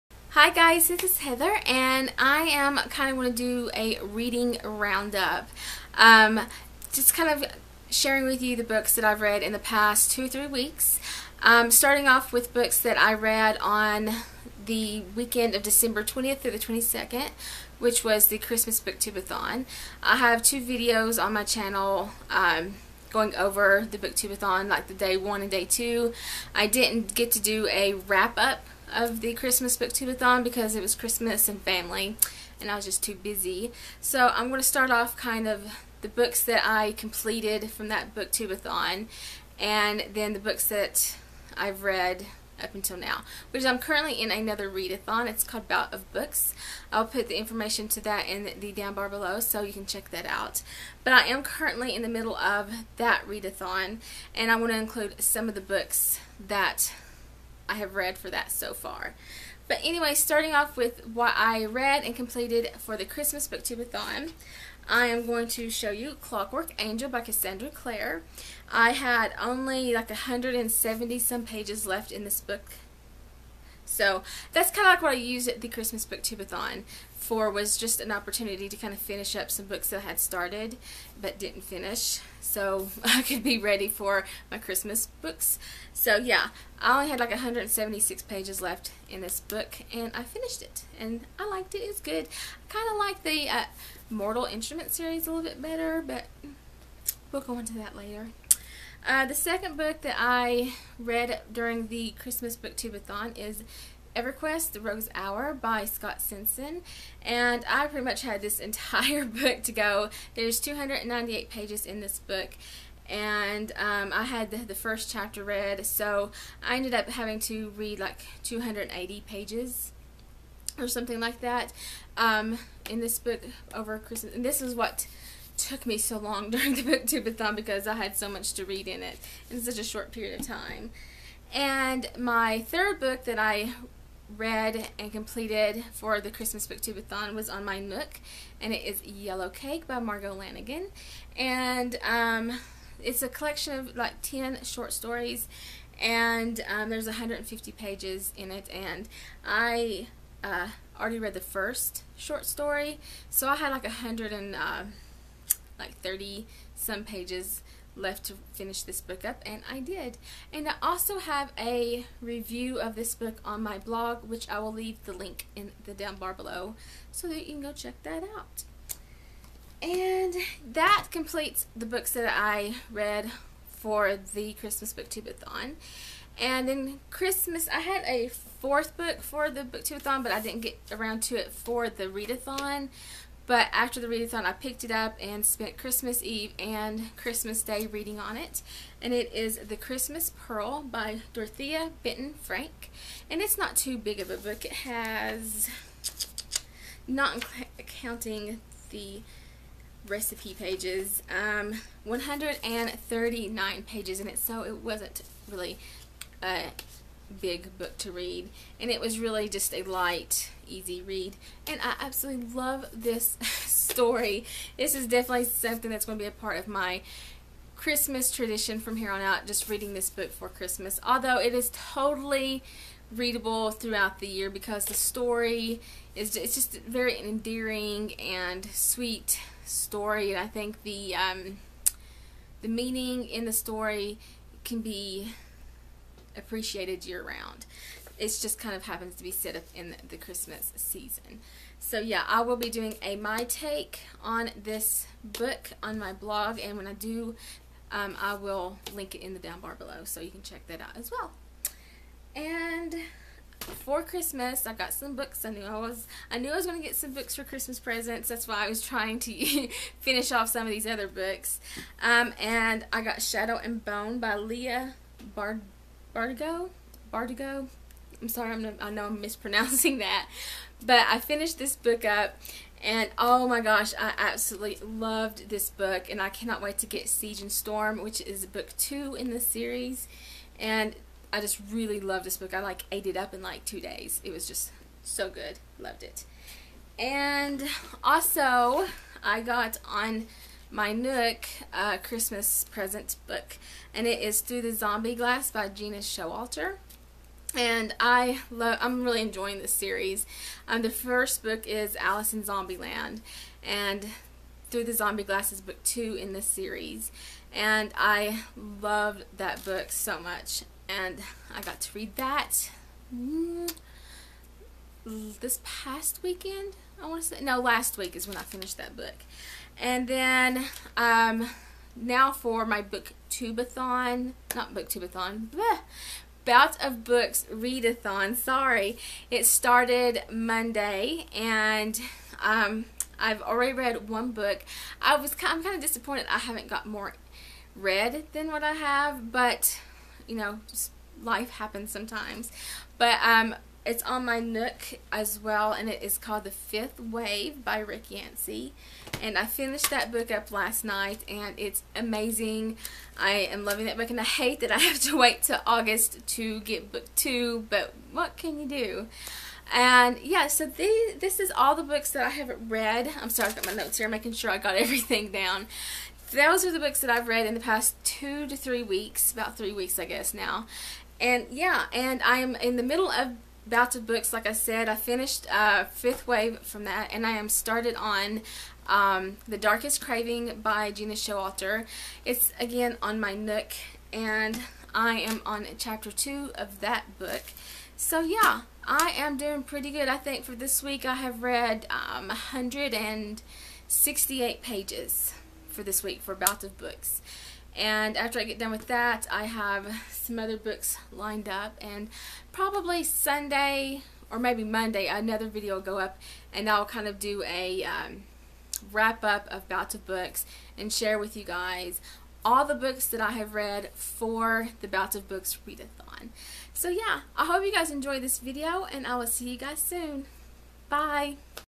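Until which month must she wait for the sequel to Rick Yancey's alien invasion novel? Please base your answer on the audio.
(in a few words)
August.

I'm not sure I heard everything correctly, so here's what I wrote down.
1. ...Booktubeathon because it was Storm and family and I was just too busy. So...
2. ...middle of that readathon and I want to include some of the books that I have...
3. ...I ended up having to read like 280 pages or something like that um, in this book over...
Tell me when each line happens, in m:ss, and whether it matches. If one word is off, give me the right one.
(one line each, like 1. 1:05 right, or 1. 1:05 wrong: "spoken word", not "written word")
1. 0:29 wrong: "Christmas", not "Storm"
2. 0:52 right
3. 1:56 right.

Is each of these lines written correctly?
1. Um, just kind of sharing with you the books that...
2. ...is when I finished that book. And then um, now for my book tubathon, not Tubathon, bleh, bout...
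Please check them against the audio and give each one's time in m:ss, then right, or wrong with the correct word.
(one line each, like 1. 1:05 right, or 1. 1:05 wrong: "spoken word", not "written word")
1. 0:05 right
2. 5:18 right.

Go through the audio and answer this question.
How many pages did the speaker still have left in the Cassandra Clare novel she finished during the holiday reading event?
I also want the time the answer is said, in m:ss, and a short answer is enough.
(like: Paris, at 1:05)
176, at 1:27.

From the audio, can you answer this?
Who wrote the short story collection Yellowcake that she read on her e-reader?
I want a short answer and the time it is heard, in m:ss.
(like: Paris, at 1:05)
Margo Lanagan, at 2:19.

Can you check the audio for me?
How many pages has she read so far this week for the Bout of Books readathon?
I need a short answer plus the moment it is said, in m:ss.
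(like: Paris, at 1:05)
168, at 6:32.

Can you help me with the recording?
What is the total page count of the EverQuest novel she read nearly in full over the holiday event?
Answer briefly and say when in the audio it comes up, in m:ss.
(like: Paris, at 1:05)
298, at 1:50.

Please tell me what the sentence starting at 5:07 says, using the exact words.
And I loved that book so much, and I got to read that.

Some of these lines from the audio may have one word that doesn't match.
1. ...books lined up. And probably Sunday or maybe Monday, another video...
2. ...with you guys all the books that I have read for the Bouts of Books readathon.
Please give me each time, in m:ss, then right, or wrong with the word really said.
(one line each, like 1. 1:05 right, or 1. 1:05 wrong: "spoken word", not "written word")
1. 6:40 right
2. 6:51 right.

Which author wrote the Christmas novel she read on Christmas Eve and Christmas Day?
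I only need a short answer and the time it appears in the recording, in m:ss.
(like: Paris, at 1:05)
Dorothea Benton Frank, at 3:11.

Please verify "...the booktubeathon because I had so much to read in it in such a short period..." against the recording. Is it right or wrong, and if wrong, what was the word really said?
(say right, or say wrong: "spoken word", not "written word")
right.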